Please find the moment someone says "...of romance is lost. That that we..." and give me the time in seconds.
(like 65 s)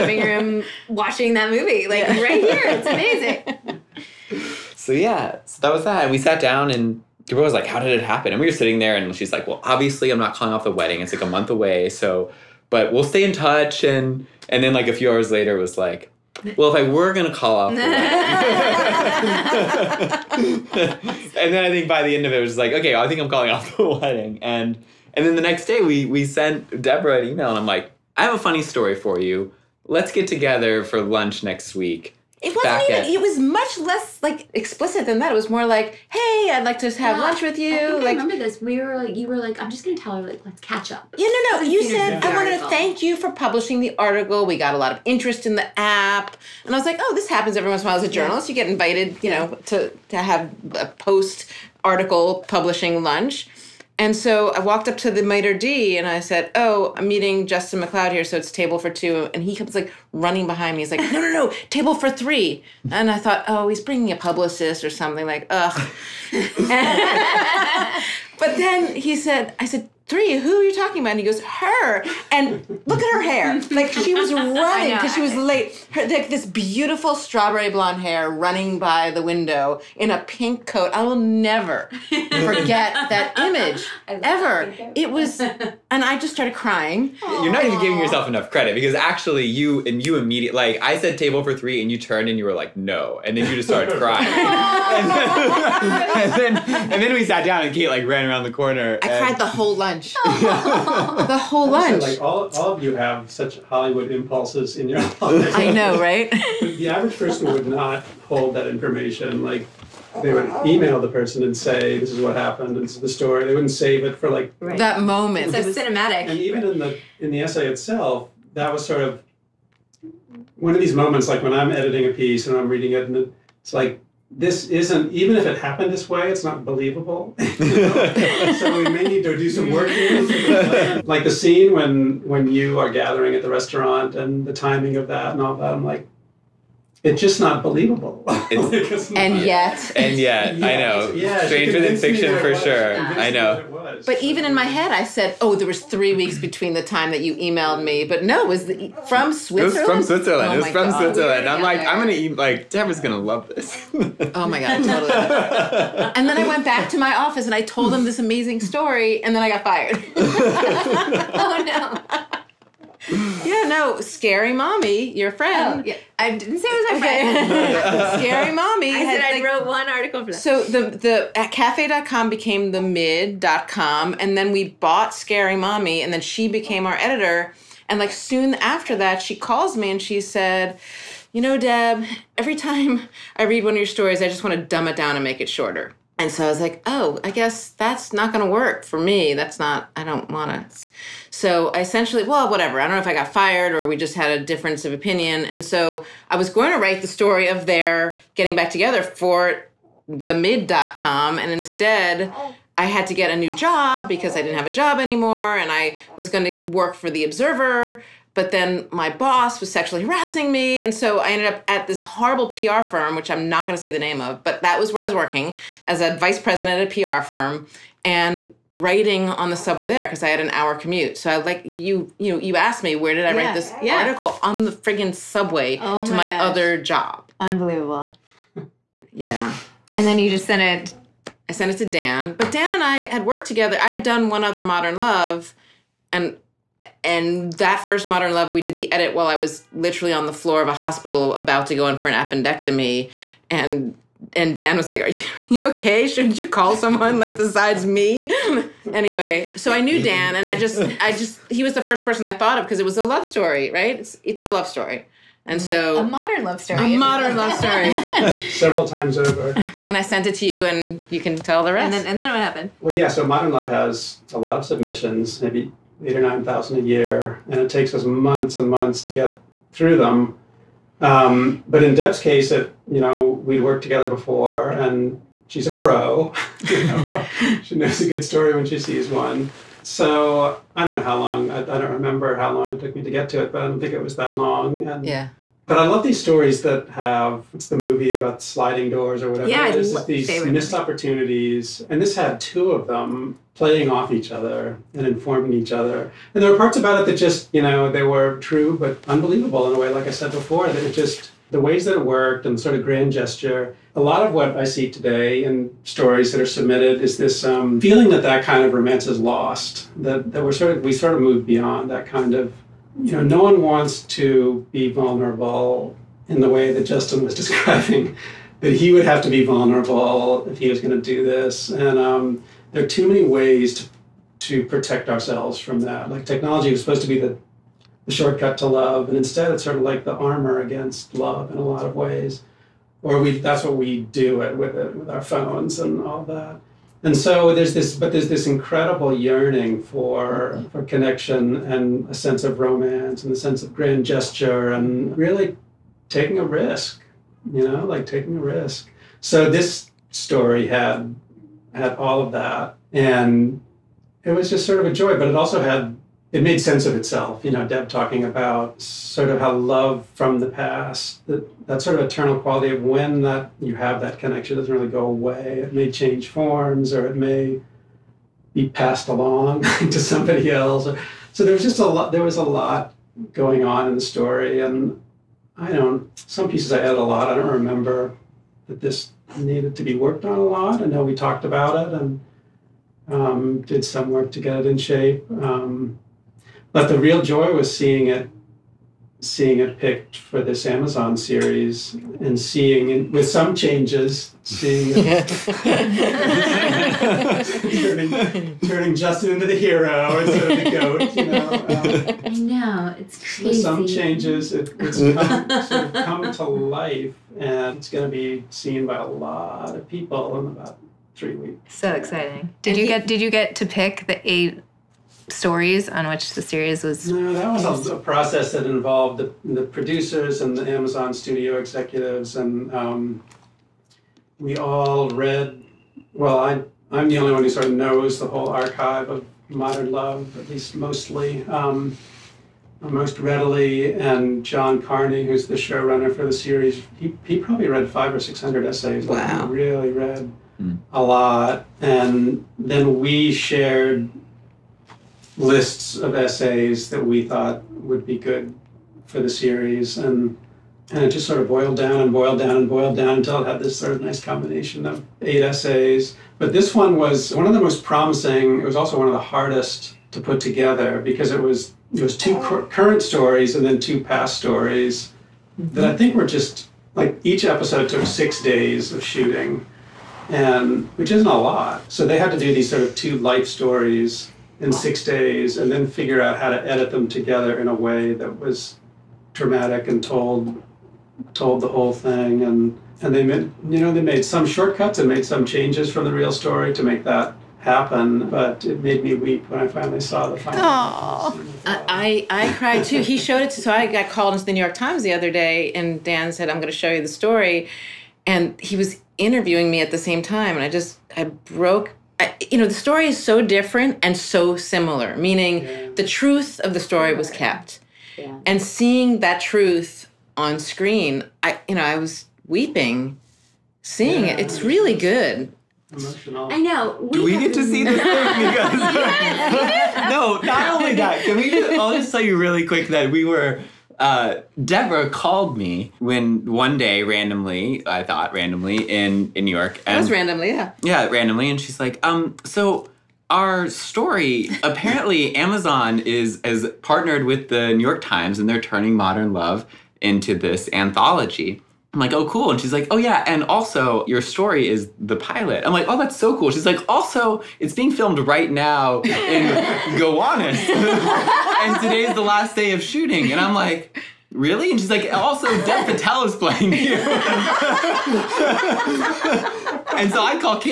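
308 s.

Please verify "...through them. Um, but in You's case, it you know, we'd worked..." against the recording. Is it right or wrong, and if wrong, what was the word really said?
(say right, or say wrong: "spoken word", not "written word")
wrong: "Deb", not "You".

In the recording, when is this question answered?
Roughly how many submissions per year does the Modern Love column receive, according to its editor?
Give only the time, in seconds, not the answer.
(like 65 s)
266 s.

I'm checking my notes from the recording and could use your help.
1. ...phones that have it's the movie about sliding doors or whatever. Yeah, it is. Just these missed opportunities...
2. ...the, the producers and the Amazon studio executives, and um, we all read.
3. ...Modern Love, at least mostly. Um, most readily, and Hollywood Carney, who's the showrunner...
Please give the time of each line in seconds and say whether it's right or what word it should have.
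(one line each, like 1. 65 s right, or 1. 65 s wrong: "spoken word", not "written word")
1. 286 s wrong: "stories", not "phones"
2. 419 s right
3. 429 s wrong: "John", not "Hollywood".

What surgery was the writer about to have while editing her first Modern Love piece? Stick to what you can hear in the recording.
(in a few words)
Appendectomy.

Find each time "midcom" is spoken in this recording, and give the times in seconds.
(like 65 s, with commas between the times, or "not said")
172 s, 200 s.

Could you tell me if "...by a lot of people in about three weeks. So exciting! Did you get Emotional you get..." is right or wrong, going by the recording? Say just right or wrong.
wrong.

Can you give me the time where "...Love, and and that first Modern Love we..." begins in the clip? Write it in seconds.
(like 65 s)
234 s.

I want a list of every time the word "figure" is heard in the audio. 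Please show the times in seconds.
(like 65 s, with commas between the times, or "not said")
475 s.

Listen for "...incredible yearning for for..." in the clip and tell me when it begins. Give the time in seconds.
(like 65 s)
338 s.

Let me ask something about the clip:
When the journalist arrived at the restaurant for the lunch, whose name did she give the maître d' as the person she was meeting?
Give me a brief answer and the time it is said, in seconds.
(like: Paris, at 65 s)
Justin McLeod, at 57 s.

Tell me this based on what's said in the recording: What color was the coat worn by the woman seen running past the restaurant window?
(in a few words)
Pink.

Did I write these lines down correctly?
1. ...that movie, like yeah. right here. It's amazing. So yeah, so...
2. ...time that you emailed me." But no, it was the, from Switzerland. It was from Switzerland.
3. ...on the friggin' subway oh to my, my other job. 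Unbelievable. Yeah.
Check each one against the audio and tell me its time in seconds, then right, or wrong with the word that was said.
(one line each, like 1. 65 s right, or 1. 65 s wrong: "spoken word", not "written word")
1. 1 s right
2. 146 s right
3. 224 s right.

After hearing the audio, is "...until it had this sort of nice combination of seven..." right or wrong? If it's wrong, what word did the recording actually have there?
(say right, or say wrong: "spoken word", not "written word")
wrong: "eight", not "seven".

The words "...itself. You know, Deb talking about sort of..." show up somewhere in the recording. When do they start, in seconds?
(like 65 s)
356 s.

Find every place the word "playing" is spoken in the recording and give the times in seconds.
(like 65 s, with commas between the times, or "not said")
293 s, 556 s.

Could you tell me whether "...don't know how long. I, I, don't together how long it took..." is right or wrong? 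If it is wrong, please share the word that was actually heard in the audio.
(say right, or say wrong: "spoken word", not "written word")
wrong: "remember", not "together".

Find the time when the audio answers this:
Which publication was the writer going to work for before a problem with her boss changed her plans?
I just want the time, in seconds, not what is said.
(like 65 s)
207 s.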